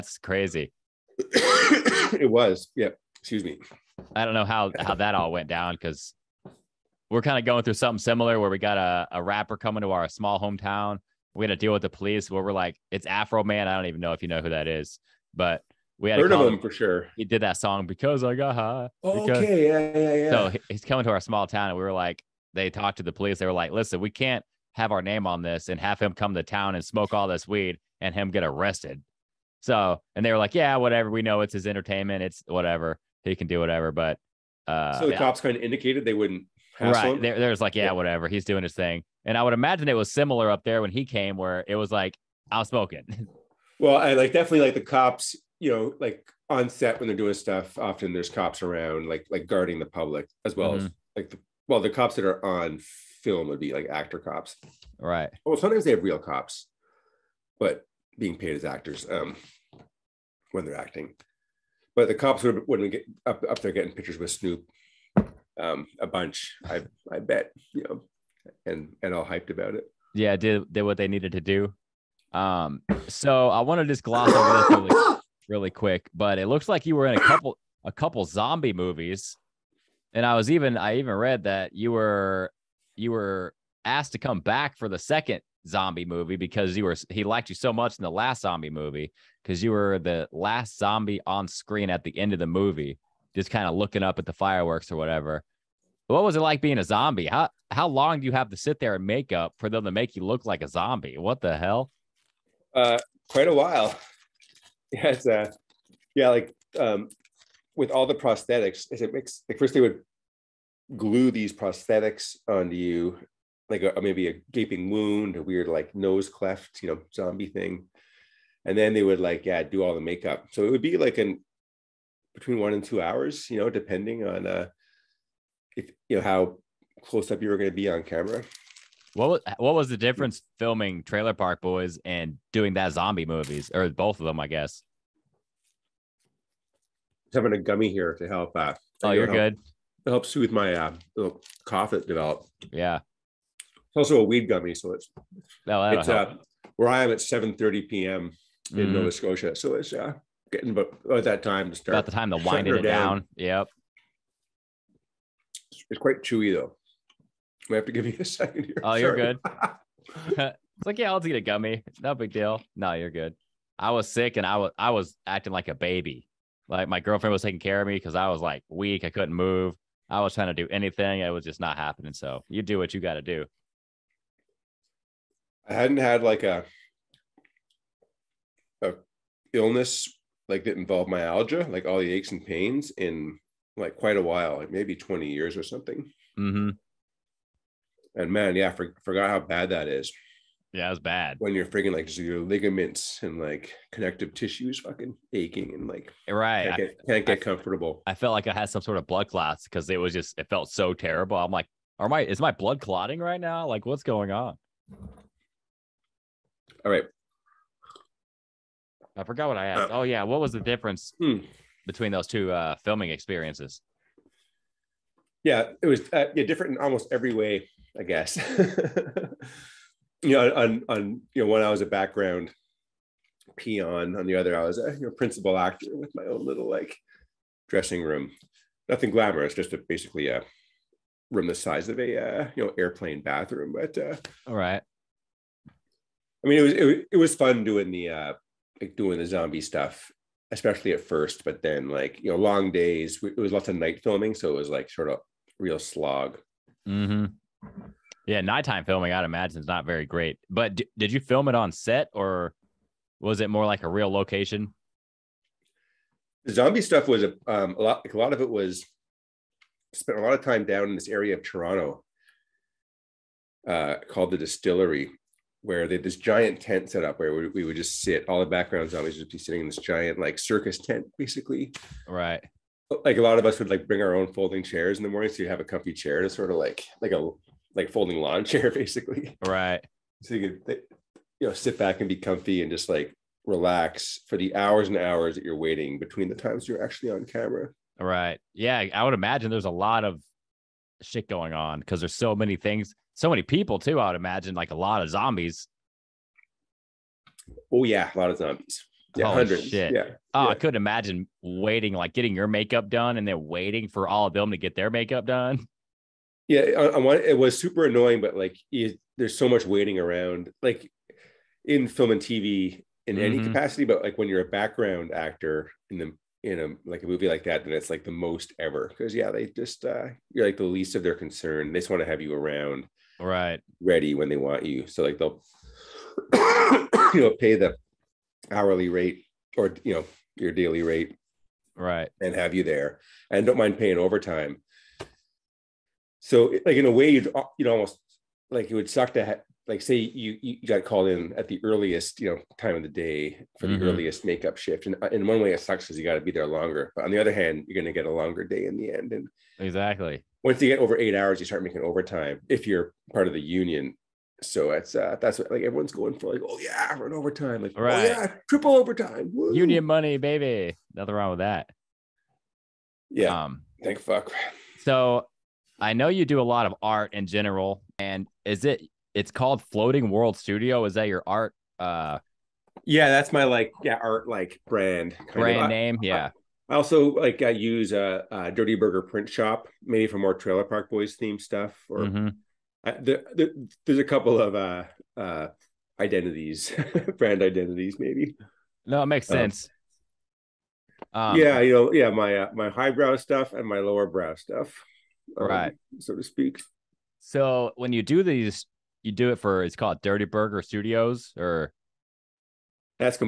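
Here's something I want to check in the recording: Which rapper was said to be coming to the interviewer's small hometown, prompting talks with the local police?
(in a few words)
Afroman.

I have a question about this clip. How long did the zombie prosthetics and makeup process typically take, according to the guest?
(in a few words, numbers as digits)
Between one and two hours.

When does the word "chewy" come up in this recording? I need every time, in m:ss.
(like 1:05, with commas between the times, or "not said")
2:36.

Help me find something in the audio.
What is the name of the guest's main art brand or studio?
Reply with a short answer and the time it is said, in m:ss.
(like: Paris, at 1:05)
Floating World Studio, at 6:09.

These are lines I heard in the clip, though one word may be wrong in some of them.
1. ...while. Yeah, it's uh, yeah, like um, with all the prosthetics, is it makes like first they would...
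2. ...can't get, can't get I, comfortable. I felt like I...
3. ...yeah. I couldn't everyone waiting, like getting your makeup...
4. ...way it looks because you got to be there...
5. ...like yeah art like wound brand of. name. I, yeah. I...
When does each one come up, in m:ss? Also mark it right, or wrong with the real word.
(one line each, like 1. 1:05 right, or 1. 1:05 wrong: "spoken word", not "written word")
1. 1:43 right
2. 3:16 right
3. 5:00 wrong: "imagine", not "everyone"
4. 5:45 wrong: "sucks", not "looks"
5. 6:13 wrong: "brand", not "wound".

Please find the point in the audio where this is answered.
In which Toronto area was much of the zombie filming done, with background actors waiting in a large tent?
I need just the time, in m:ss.
4:24.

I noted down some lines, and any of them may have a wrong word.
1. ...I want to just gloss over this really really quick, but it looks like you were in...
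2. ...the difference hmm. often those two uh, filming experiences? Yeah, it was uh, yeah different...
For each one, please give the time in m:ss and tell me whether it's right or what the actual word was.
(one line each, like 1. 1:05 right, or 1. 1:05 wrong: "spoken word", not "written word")
1. 1:13 right
2. 3:30 wrong: "between", not "often".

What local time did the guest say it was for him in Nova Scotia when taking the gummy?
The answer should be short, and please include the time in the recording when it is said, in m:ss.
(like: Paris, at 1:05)
7:30 p.m., at 2:27.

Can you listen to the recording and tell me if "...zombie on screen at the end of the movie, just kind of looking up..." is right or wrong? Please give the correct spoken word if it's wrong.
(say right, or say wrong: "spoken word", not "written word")
right.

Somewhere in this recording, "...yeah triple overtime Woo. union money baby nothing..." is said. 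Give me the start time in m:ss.
5:58.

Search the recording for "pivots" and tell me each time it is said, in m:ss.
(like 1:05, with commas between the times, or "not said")
not said.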